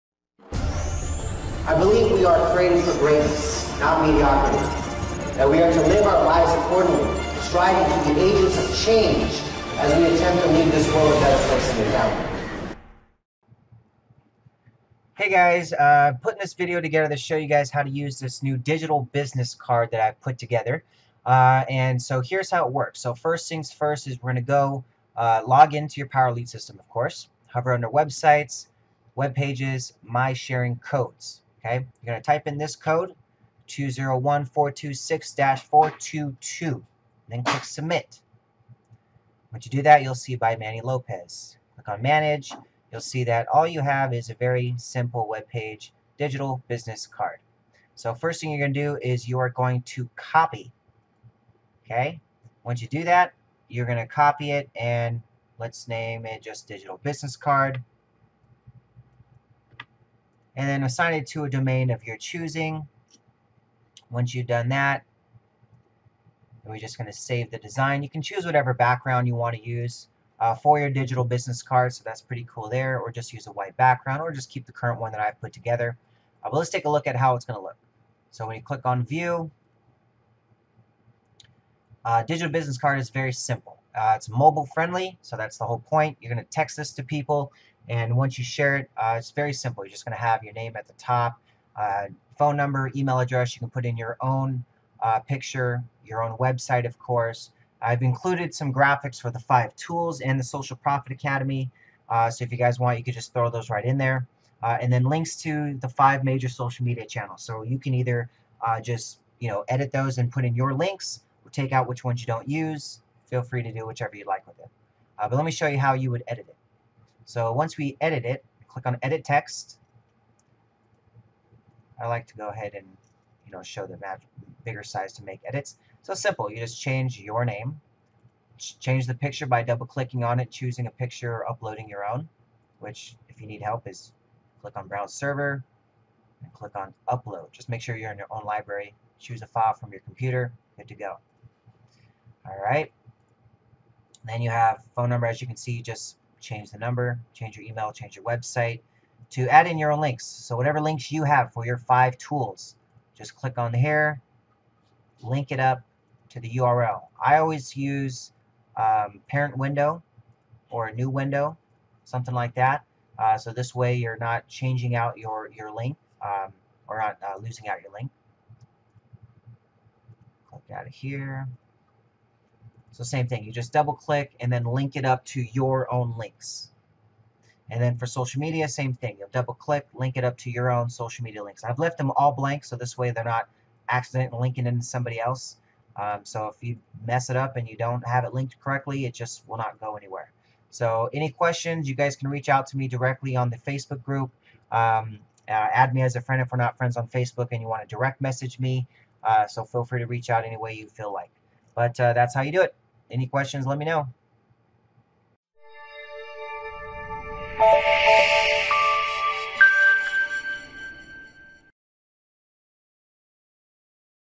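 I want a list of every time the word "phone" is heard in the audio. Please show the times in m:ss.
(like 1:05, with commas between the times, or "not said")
1:32, 2:24.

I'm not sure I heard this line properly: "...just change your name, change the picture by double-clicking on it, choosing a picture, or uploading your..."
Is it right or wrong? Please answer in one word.
right.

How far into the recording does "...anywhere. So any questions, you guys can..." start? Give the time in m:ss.
3:09.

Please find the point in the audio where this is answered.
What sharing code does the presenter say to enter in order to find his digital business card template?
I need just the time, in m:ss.
0:33.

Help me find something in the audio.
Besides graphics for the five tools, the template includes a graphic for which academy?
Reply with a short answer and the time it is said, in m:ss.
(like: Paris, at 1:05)
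Social Profit Academy, at 1:40.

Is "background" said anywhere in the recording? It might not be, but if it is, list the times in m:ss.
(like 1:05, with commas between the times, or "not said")
1:08, 1:13.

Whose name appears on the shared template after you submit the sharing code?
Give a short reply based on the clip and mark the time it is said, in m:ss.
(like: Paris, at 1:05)
Manny Lopez, at 0:40.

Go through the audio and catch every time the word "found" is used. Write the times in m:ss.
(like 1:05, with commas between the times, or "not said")
0:11.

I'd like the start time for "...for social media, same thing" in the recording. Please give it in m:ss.
2:57.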